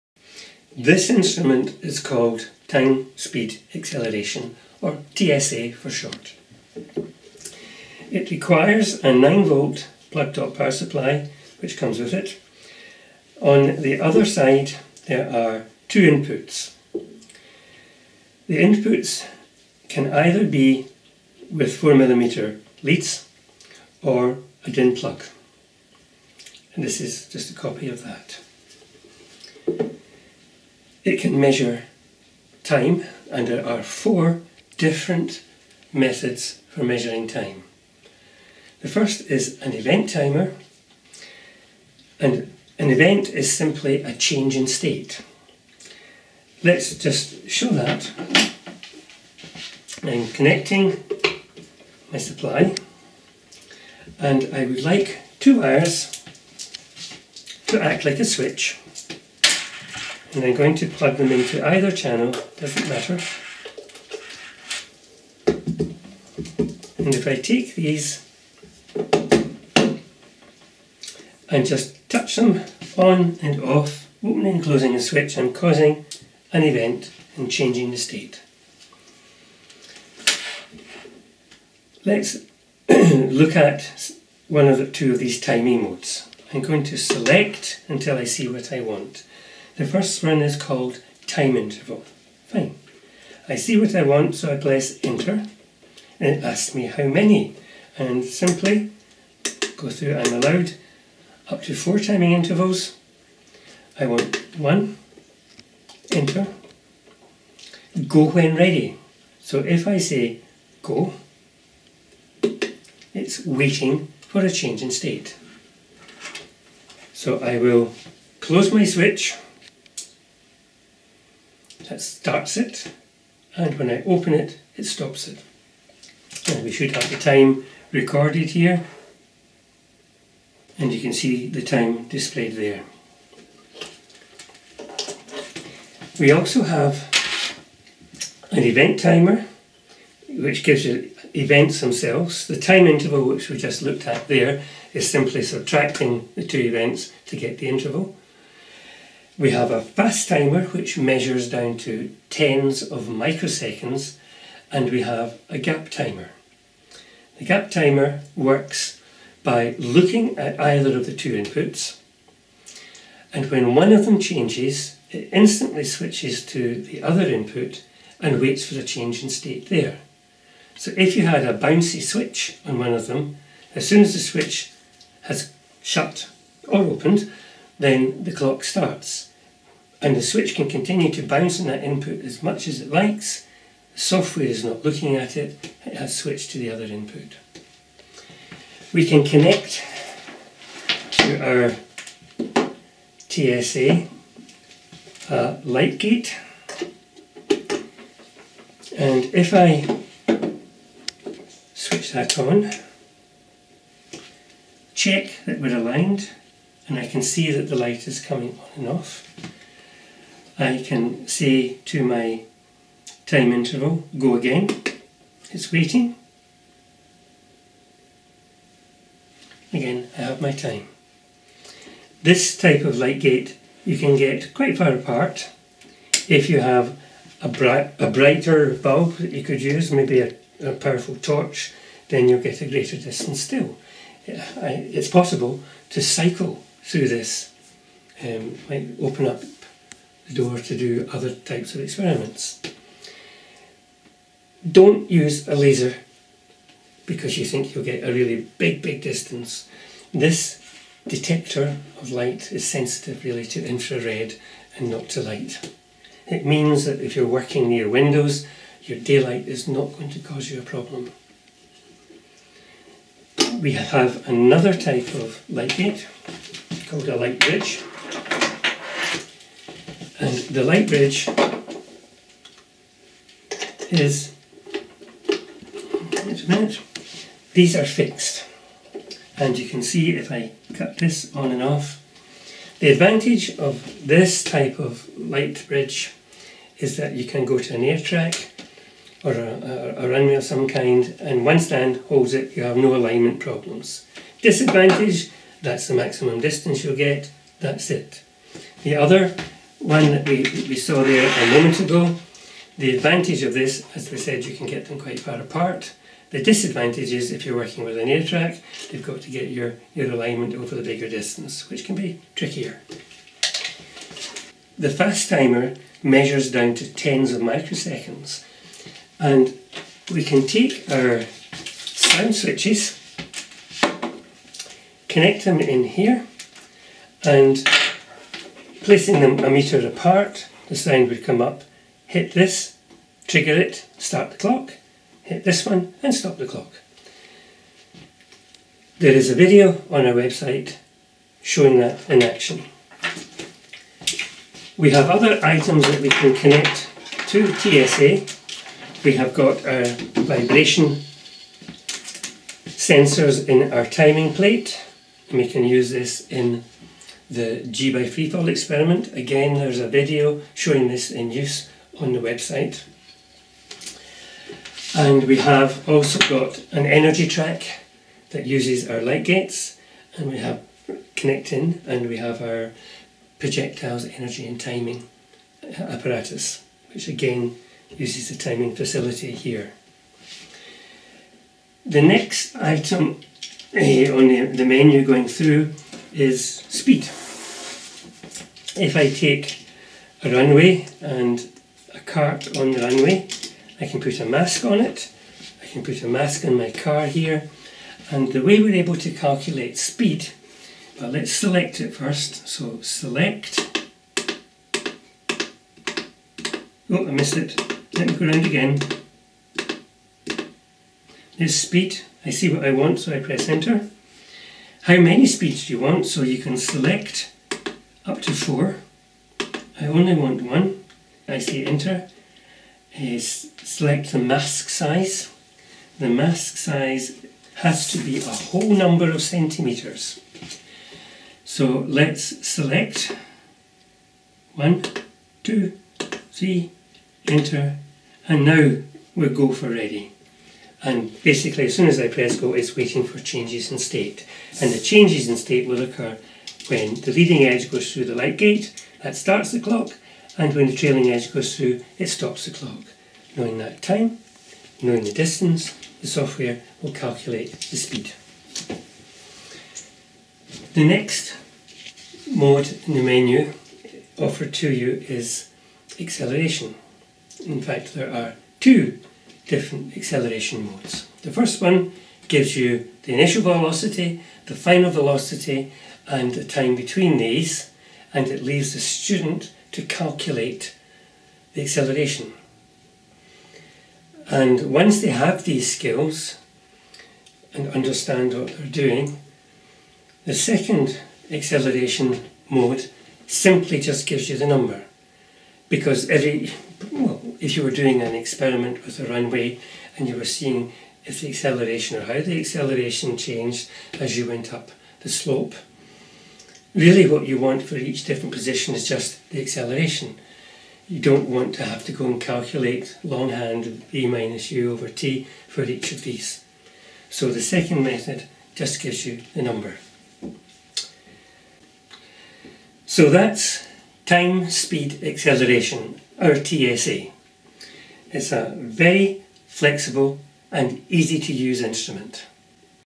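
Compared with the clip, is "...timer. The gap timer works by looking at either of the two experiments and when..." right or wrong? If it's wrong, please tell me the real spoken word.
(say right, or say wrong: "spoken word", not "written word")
wrong: "inputs", not "experiments".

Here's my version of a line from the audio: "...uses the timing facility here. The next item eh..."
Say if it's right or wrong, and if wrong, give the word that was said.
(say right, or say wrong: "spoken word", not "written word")
right.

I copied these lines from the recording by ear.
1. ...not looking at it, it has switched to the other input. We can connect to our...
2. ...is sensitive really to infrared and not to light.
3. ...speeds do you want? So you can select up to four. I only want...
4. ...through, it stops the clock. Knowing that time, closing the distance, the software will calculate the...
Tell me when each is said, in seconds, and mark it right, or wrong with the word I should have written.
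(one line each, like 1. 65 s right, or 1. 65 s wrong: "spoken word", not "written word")
1. 184 s right
2. 252 s right
3. 415 s right
4. 451 s wrong: "knowing", not "closing".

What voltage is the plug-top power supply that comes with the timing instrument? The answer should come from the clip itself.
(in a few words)
9 volt.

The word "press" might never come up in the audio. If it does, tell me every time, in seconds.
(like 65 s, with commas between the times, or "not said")
94 s, 413 s, 442 s.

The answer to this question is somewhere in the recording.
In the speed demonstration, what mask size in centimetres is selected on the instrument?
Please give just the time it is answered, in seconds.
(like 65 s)
436 s.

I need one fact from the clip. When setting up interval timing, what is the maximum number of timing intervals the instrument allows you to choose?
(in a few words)
4.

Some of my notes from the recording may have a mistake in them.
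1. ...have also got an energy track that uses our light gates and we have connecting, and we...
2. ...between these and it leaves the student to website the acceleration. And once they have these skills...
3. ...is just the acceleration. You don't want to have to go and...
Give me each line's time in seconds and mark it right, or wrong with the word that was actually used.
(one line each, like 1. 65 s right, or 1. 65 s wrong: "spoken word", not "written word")
1. 365 s right
2. 476 s wrong: "calculate", not "website"
3. 508 s right.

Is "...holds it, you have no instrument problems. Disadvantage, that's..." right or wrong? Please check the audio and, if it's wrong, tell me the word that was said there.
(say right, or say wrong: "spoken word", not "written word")
wrong: "alignment", not "instrument".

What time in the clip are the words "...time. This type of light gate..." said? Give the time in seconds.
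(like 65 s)
220 s.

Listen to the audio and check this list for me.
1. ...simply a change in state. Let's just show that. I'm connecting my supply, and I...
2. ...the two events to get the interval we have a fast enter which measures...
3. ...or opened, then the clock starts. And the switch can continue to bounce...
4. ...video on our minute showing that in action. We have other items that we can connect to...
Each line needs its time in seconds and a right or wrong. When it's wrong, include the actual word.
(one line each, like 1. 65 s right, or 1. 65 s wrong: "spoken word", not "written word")
1. 43 s right
2. 146 s wrong: "timer", not "enter"
3. 176 s right
4. 339 s wrong: "website", not "minute".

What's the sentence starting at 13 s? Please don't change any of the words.
On the other side there are two inputs.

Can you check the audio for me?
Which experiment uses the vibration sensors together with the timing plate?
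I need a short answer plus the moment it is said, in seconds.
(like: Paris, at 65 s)
G by freefall, at 357 s.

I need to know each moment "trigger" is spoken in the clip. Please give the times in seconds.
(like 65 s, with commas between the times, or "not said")
333 s.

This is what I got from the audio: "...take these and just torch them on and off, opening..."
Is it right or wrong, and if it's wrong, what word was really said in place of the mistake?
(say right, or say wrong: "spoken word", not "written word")
wrong: "touch", not "torch".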